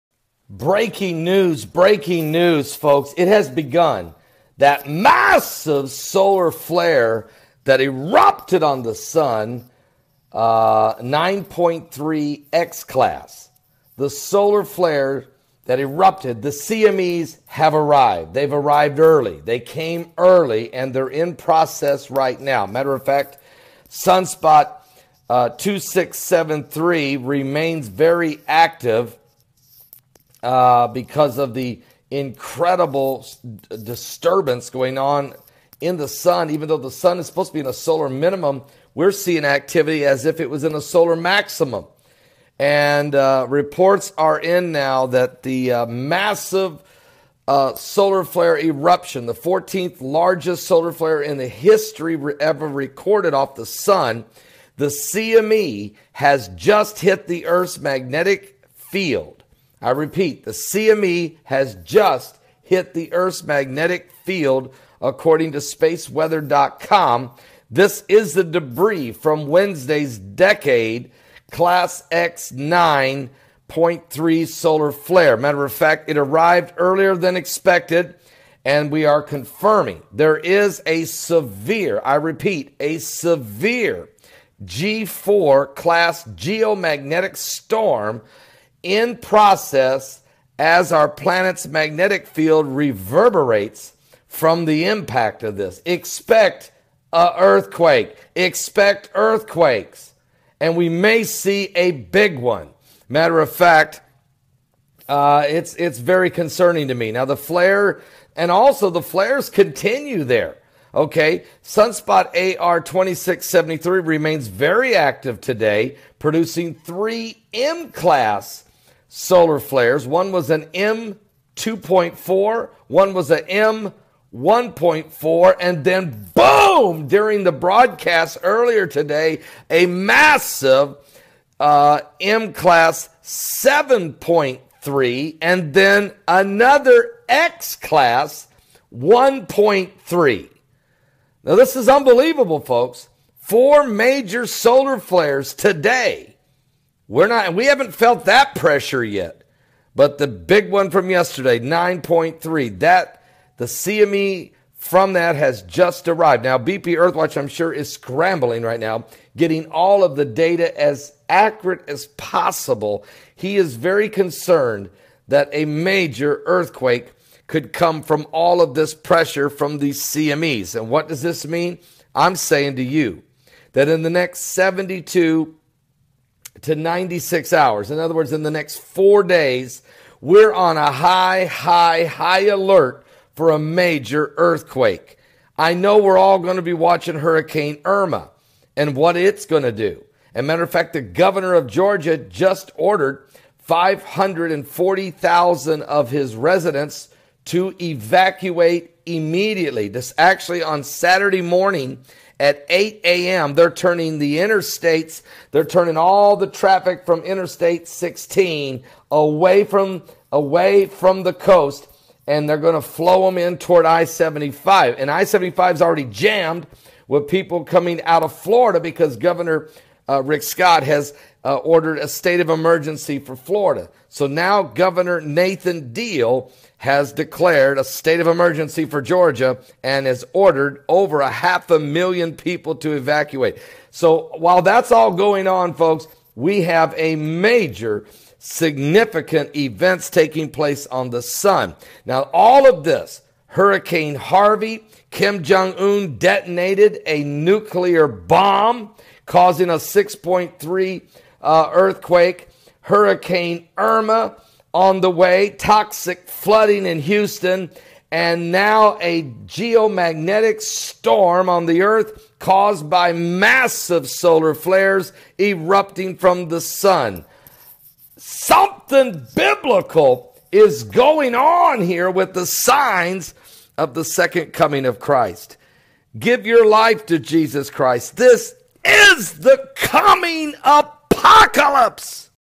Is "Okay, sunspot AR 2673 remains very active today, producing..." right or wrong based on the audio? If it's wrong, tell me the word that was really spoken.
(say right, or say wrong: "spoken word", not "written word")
right.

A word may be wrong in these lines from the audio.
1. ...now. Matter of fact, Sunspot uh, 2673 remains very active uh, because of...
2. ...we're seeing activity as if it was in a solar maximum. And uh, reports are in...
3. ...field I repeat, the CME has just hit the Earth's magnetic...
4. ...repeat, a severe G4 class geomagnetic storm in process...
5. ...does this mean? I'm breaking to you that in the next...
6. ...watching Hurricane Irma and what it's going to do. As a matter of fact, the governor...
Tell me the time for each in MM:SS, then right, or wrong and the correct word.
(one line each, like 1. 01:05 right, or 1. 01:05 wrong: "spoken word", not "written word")
1. 00:22 right
2. 00:38 right
3. 00:58 right
4. 01:22 right
5. 02:51 wrong: "saying", not "breaking"
6. 03:06 right.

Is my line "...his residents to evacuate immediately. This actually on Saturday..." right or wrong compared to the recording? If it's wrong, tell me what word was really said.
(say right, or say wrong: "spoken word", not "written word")
right.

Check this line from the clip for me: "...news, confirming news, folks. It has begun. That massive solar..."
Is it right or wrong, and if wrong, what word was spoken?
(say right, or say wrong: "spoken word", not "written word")
wrong: "breaking", not "confirming".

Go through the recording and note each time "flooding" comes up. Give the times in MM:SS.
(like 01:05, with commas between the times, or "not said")
04:16.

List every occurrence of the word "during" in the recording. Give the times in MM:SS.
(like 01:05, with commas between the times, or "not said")
02:07.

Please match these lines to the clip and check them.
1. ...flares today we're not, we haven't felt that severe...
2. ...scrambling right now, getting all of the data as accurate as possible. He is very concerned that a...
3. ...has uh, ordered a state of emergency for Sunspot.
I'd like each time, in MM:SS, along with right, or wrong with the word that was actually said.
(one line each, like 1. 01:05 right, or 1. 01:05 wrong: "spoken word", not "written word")
1. 02:24 wrong: "pressure", not "severe"
2. 02:37 right
3. 03:40 wrong: "Florida", not "Sunspot".